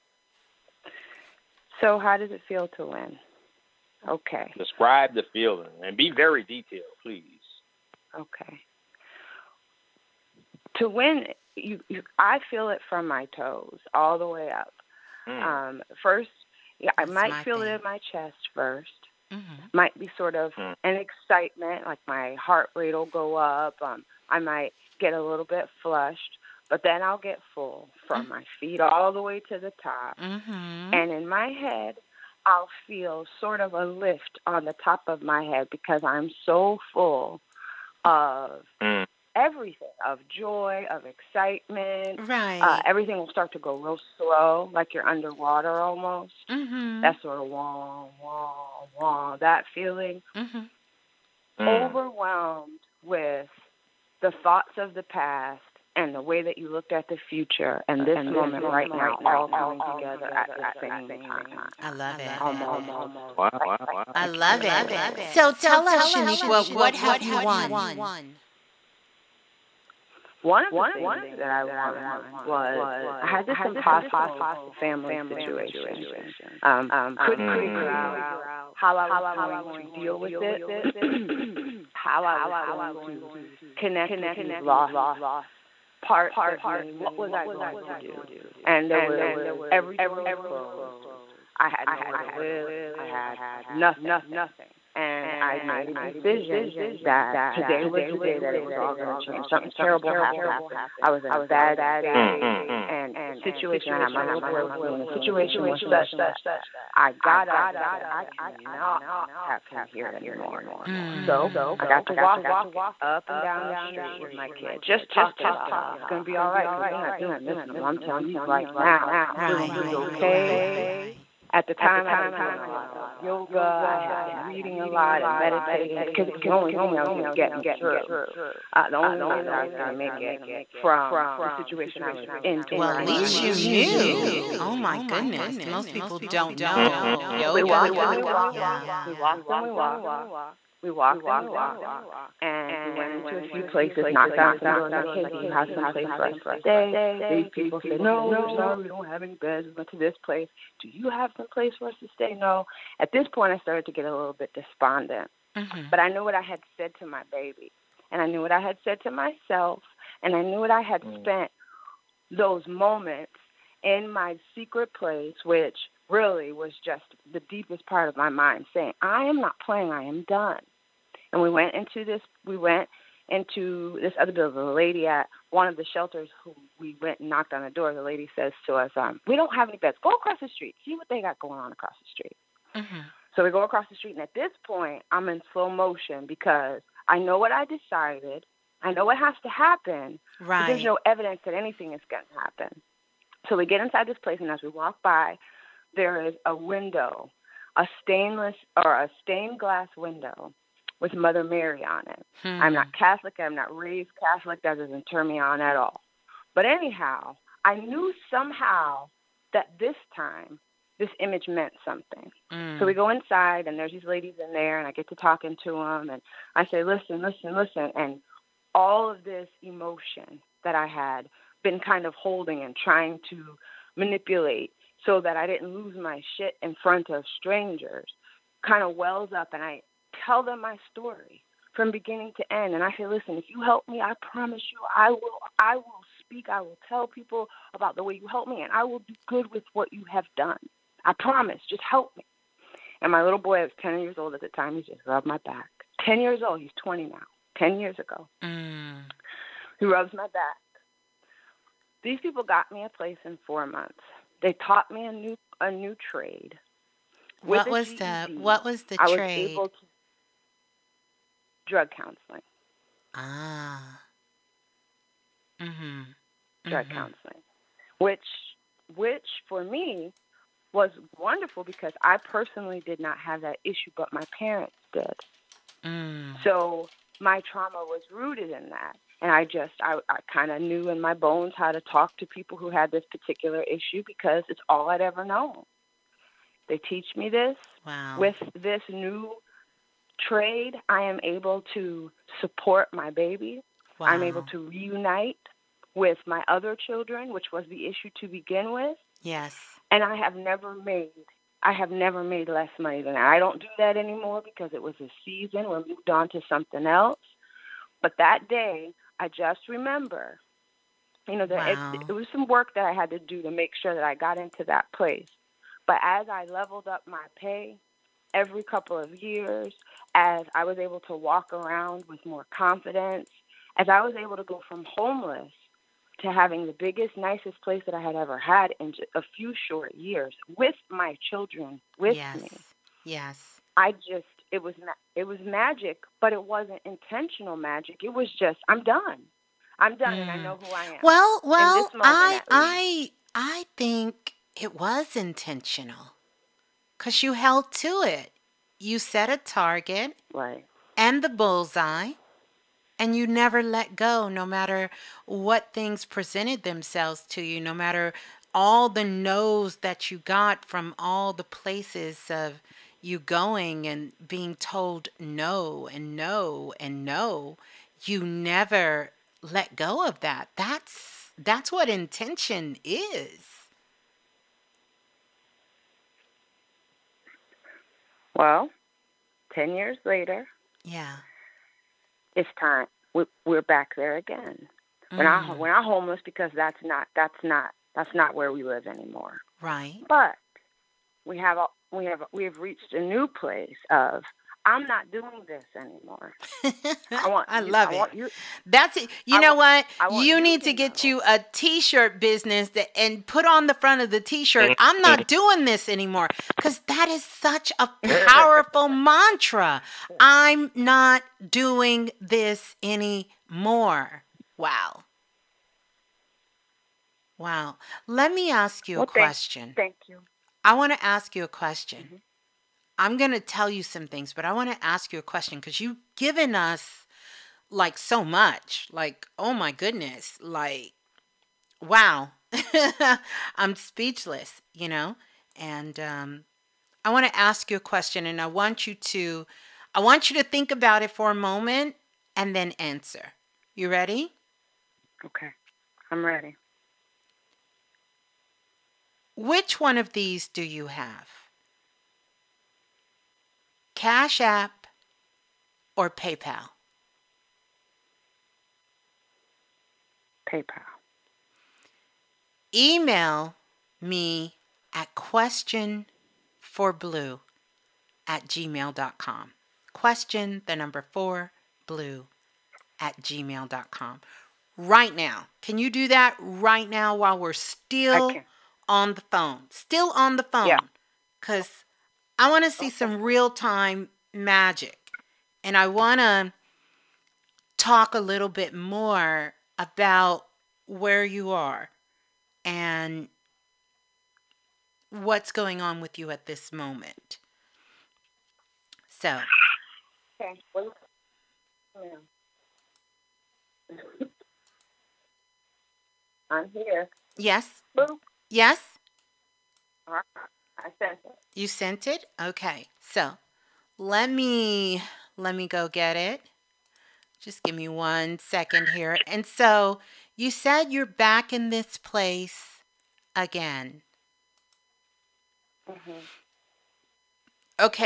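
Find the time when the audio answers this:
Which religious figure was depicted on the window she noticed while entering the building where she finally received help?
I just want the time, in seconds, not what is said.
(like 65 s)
201 s.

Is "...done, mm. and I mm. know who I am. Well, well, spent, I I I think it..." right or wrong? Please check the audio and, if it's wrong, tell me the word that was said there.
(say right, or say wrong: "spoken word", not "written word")
wrong: "moment", not "spent".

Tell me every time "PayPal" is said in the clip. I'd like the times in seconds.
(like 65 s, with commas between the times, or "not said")
456 s, 460 s.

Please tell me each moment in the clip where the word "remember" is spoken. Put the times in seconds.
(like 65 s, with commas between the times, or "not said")
309 s.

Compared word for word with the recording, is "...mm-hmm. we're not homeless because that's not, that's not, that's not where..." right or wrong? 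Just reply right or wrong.
right.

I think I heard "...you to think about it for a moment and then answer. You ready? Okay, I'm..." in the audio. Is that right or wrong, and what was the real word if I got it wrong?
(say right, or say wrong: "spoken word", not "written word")
right.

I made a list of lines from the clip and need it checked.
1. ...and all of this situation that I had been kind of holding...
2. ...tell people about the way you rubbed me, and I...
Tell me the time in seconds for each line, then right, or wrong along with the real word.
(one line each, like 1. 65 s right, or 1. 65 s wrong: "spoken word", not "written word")
1. 217 s wrong: "emotion", not "situation"
2. 236 s wrong: "helped", not "rubbed".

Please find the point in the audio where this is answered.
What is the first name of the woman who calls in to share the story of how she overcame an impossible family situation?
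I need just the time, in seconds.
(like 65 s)
66 s.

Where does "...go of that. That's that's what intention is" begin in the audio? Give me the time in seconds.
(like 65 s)
369 s.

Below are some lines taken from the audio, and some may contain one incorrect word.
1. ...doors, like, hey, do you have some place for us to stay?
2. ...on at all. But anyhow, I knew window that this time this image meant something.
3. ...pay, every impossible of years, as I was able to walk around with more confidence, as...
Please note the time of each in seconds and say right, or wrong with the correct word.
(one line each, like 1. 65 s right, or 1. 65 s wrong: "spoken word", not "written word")
1. 144 s right
2. 205 s wrong: "somehow", not "window"
3. 317 s wrong: "couple", not "impossible".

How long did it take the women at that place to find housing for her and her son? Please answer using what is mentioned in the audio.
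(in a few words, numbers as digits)
4 months.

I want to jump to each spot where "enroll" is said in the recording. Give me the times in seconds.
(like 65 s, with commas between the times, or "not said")
not said.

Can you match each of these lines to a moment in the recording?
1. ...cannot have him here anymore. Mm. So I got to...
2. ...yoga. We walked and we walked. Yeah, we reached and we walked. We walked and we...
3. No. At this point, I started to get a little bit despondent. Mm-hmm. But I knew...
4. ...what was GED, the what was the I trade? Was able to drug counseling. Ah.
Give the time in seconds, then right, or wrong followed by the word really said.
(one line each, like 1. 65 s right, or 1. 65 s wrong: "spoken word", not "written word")
1. 108 s right
2. 137 s wrong: "walked", not "reached"
3. 152 s right
4. 257 s right.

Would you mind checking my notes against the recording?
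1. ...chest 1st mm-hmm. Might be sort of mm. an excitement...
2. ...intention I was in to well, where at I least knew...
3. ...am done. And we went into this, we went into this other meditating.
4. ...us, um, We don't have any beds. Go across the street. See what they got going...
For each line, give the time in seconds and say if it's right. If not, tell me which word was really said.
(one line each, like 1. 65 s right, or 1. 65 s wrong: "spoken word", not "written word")
1. 18 s right
2. 131 s wrong: "situation", not "intention"
3. 170 s wrong: "building", not "meditating"
4. 178 s right.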